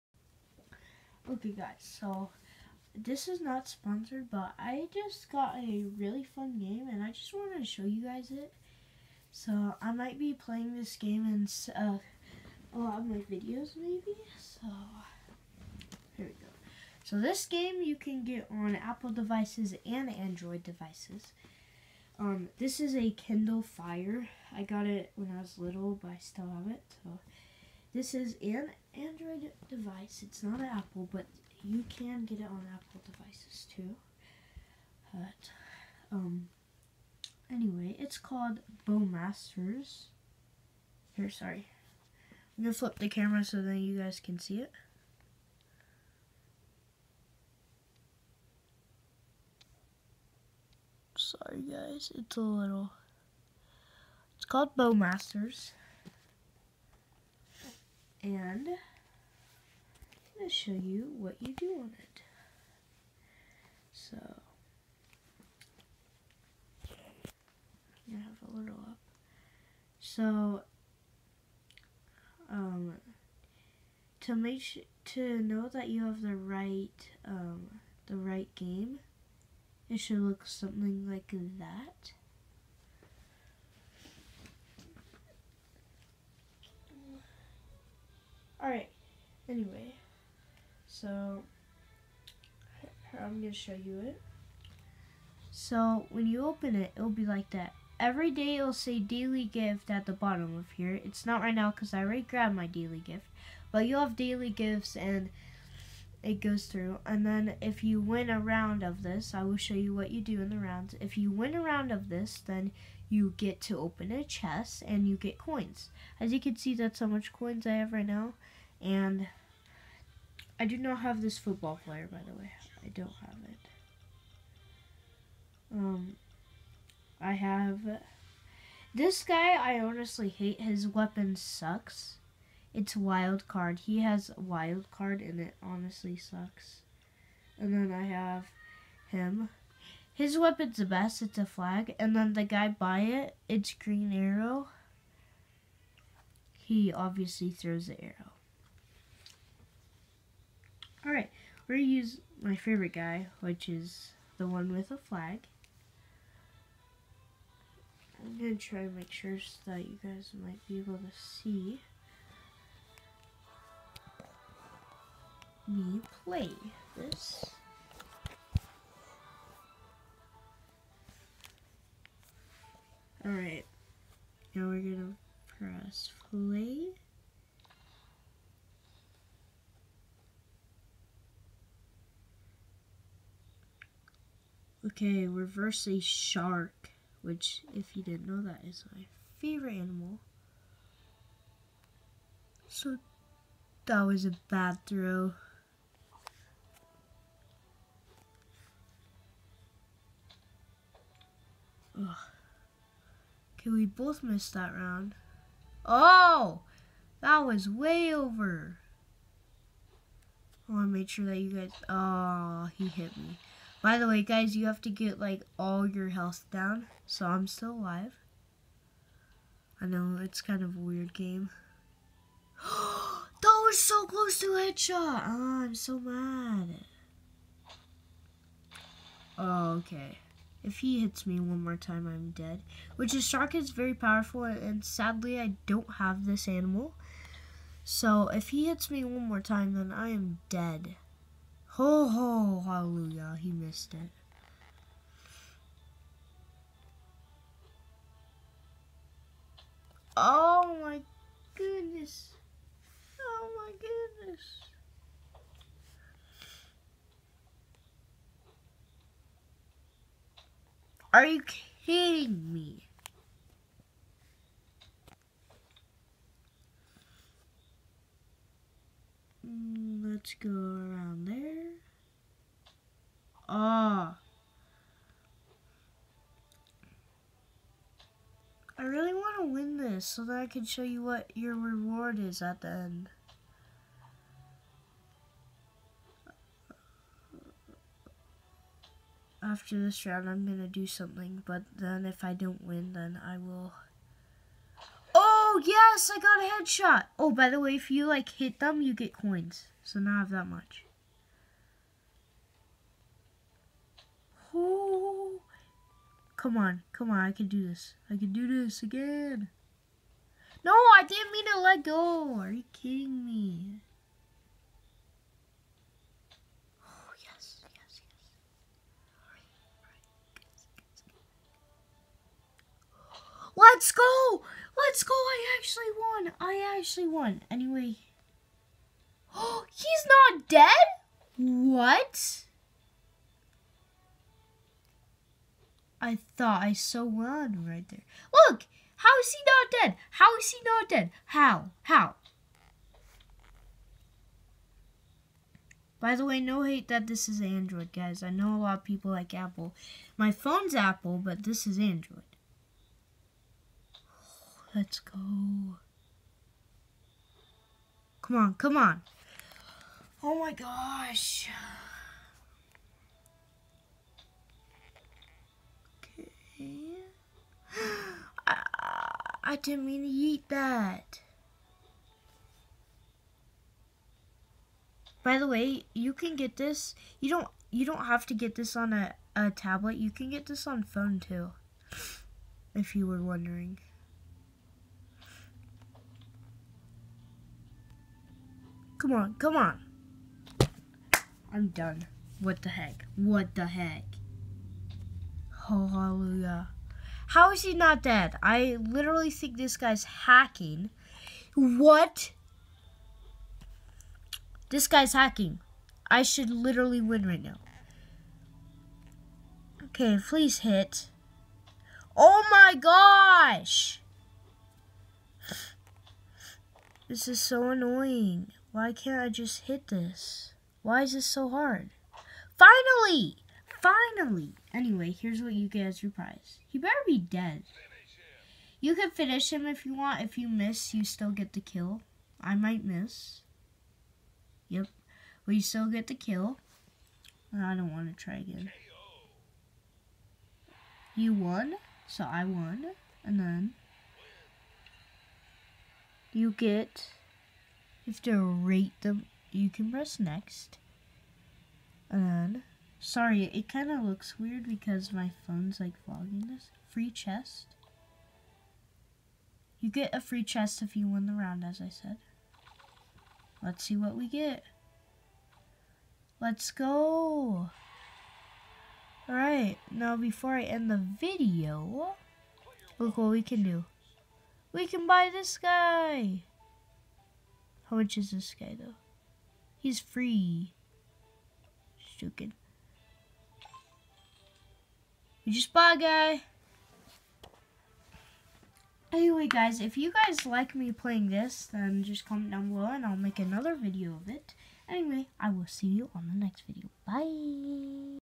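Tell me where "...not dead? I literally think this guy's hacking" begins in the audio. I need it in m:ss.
6:37.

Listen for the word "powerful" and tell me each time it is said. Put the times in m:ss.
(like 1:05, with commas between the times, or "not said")
3:53.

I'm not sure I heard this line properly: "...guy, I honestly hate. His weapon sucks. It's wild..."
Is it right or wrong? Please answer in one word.
right.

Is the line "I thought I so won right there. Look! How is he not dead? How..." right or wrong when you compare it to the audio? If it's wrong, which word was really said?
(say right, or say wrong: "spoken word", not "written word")
right.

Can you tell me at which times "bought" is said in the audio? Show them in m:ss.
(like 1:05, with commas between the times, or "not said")
8:05.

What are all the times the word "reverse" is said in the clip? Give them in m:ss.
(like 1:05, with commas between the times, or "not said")
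3:05.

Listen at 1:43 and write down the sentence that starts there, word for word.
But you'll have daily gifts and it goes through.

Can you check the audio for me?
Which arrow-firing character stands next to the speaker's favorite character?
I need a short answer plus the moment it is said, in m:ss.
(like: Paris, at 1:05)
Green Arrow, at 2:23.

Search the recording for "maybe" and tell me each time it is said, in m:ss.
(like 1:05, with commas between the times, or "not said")
0:13.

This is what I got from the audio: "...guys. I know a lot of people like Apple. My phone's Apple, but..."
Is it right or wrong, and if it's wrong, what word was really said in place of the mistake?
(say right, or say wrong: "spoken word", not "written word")
right.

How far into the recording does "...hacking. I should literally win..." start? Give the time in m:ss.
6:45.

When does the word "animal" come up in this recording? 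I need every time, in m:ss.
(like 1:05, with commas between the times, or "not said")
3:09, 3:56.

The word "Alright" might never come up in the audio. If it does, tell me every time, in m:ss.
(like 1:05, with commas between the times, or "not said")
1:28, 2:31, 2:53, 7:49.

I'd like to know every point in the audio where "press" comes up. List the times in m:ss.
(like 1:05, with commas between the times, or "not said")
2:55, 7:29.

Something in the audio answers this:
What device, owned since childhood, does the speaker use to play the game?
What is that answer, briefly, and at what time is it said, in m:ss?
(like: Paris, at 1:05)
Kindle Fire, at 0:23.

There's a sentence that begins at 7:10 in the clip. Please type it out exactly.
If you miss, you still get the kill.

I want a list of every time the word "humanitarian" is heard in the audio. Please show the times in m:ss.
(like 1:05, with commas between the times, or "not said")
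not said.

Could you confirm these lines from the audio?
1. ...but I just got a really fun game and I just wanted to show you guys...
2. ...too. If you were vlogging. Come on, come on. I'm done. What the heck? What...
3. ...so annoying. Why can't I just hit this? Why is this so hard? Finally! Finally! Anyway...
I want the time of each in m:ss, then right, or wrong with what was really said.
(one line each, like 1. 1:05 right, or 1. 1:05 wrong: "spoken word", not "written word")
1. 0:04 right
2. 6:21 wrong: "wondering", not "vlogging"
3. 6:57 right.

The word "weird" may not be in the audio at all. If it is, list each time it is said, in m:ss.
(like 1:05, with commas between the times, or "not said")
3:40, 7:34.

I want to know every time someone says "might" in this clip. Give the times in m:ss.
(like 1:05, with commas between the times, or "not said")
0:09, 2:40, 7:12.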